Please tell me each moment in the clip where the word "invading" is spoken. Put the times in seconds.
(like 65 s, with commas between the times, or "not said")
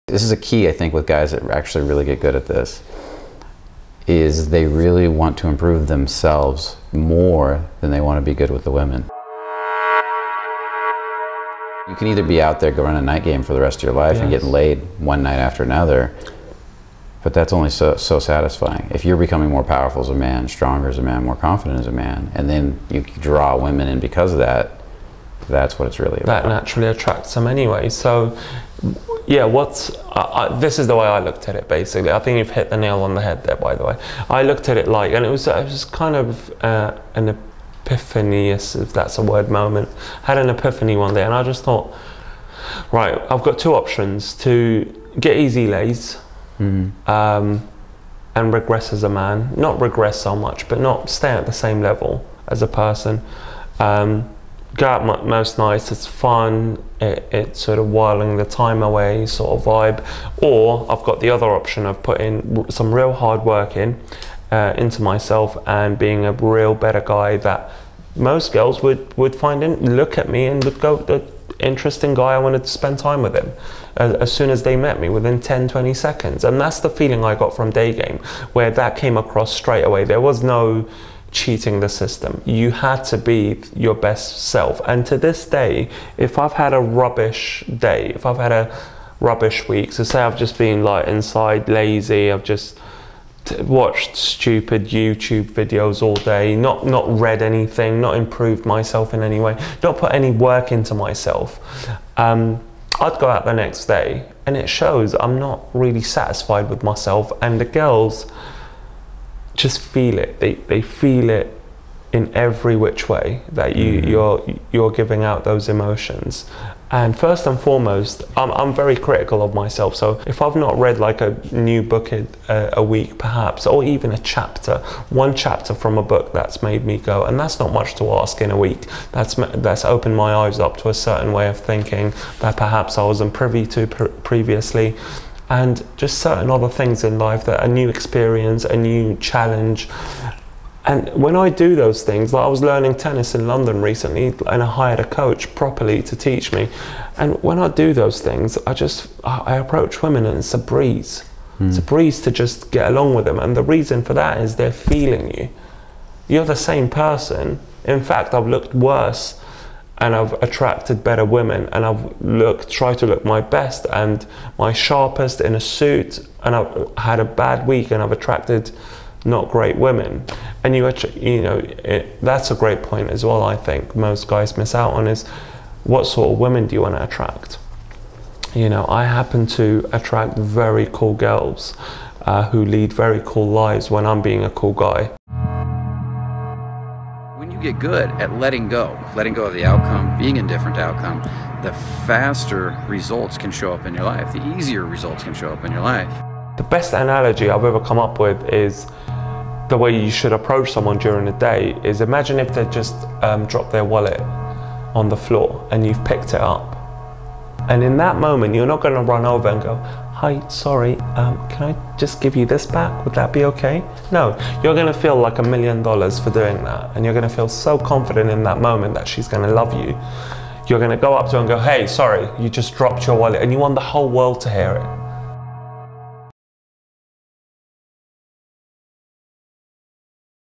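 not said.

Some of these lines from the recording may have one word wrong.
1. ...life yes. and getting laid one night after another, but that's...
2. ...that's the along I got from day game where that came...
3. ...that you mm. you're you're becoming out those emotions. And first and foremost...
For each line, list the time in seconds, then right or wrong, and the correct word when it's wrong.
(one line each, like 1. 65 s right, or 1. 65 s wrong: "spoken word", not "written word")
1. 13 s right
2. 76 s wrong: "feeling", not "along"
3. 113 s wrong: "giving", not "becoming".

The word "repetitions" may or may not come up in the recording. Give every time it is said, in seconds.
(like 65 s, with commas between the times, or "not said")
not said.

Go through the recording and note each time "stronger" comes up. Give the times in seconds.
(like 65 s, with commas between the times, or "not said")
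20 s.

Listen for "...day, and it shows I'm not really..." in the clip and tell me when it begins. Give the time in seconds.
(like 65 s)
103 s.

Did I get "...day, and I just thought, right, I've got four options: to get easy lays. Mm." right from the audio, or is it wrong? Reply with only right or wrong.
wrong.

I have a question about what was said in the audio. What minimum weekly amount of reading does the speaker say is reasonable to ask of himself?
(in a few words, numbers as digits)
one chapter.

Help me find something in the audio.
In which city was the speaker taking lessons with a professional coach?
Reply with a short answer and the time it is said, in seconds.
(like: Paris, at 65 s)
London, at 143 s.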